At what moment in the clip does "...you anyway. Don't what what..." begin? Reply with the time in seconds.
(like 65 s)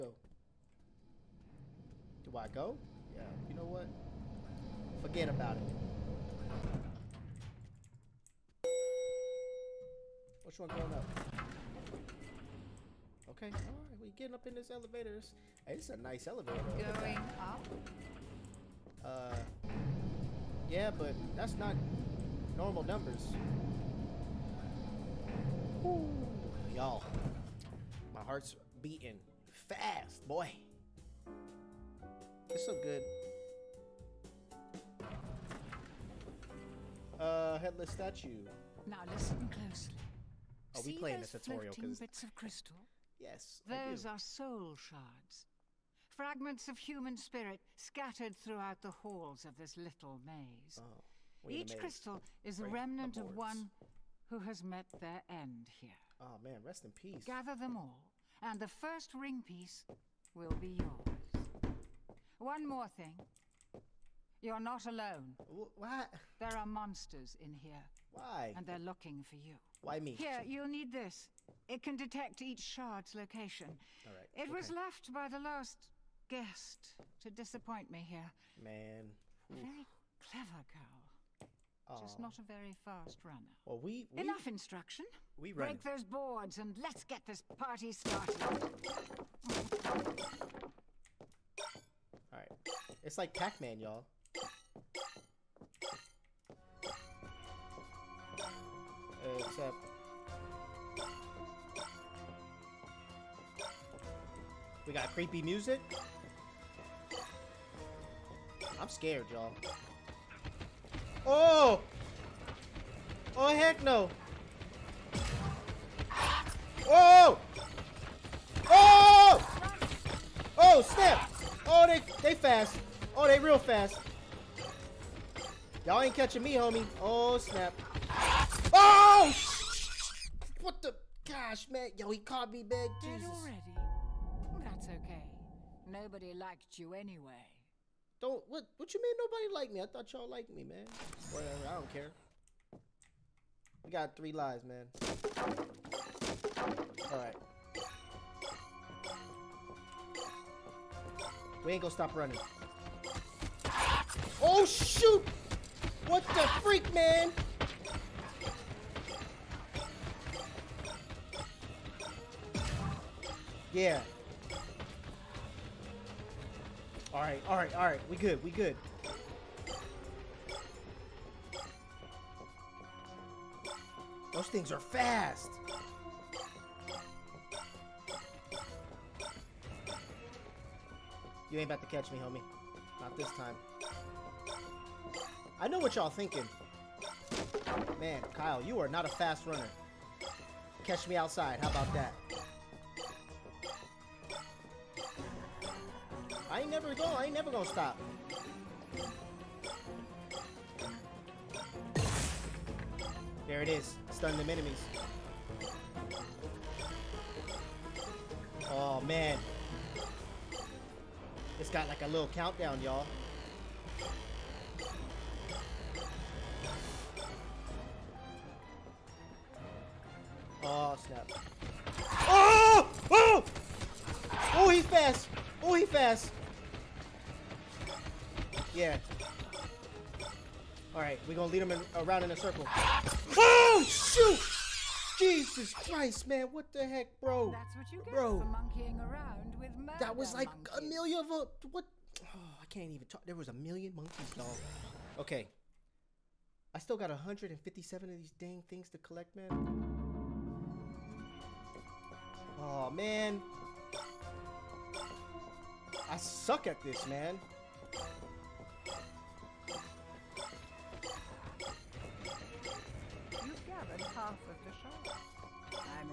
136 s.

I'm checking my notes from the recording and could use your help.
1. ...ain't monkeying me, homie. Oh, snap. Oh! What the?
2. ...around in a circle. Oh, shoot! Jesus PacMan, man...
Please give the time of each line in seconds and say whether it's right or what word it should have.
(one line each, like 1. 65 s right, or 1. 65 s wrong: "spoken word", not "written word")
1. 126 s wrong: "catching", not "monkeying"
2. 231 s wrong: "Christ", not "PacMan".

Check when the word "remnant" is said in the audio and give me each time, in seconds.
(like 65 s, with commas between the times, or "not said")
52 s.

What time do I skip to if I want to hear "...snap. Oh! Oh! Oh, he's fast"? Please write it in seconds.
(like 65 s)
221 s.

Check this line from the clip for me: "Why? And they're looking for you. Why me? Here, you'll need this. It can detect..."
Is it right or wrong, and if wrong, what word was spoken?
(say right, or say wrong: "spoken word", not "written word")
right.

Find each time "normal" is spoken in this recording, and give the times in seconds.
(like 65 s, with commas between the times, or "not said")
22 s.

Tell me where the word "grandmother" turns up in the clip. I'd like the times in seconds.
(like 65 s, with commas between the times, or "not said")
not said.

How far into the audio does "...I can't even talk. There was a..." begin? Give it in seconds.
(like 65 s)
242 s.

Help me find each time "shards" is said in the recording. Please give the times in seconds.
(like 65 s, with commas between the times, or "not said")
44 s, 72 s.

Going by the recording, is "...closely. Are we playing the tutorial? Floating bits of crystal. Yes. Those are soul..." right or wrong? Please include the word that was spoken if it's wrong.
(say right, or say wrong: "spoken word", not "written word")
right.